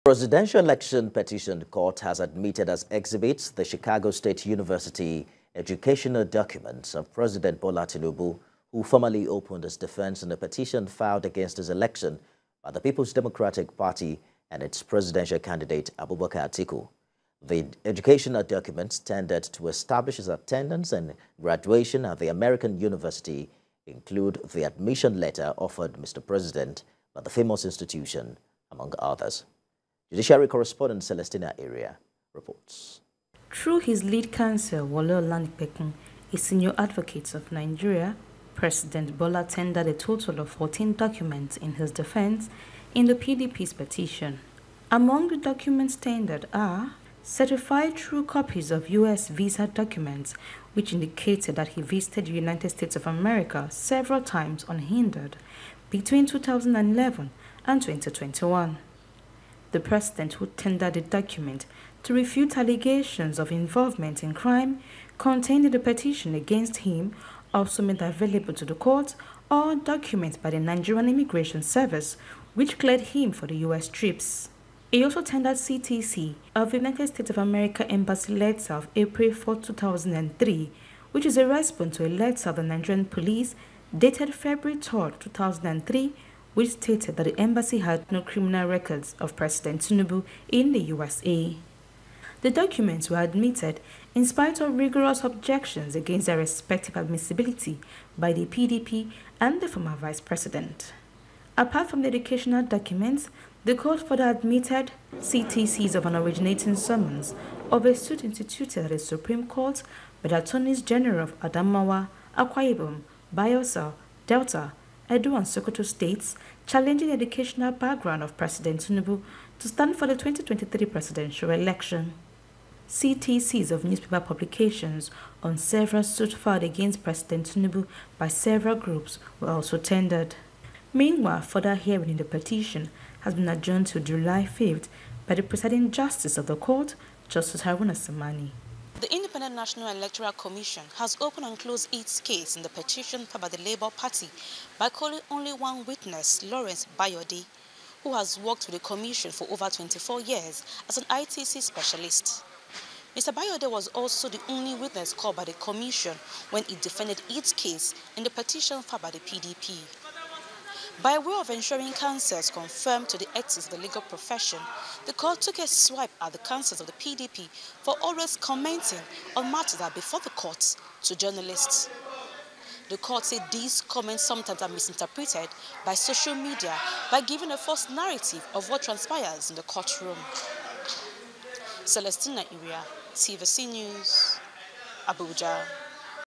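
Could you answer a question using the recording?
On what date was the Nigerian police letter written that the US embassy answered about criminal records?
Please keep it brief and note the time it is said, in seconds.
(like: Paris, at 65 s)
February 3, 2003, at 84 s.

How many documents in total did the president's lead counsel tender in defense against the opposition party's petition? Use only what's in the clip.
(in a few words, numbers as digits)
14.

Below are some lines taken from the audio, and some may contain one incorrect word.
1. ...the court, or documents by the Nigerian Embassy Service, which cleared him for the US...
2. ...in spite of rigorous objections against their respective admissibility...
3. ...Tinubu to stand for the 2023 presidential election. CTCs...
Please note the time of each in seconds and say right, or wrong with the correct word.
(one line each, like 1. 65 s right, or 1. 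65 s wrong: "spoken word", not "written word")
1. 68 s wrong: "Immigration", not "Embassy"
2. 94 s right
3. 118 s right.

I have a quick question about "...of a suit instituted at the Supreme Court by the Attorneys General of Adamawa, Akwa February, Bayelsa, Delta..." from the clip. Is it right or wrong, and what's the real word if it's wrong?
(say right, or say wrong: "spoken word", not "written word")
wrong: "Ibom", not "February".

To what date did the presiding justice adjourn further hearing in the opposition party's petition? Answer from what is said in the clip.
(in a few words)
July 5th.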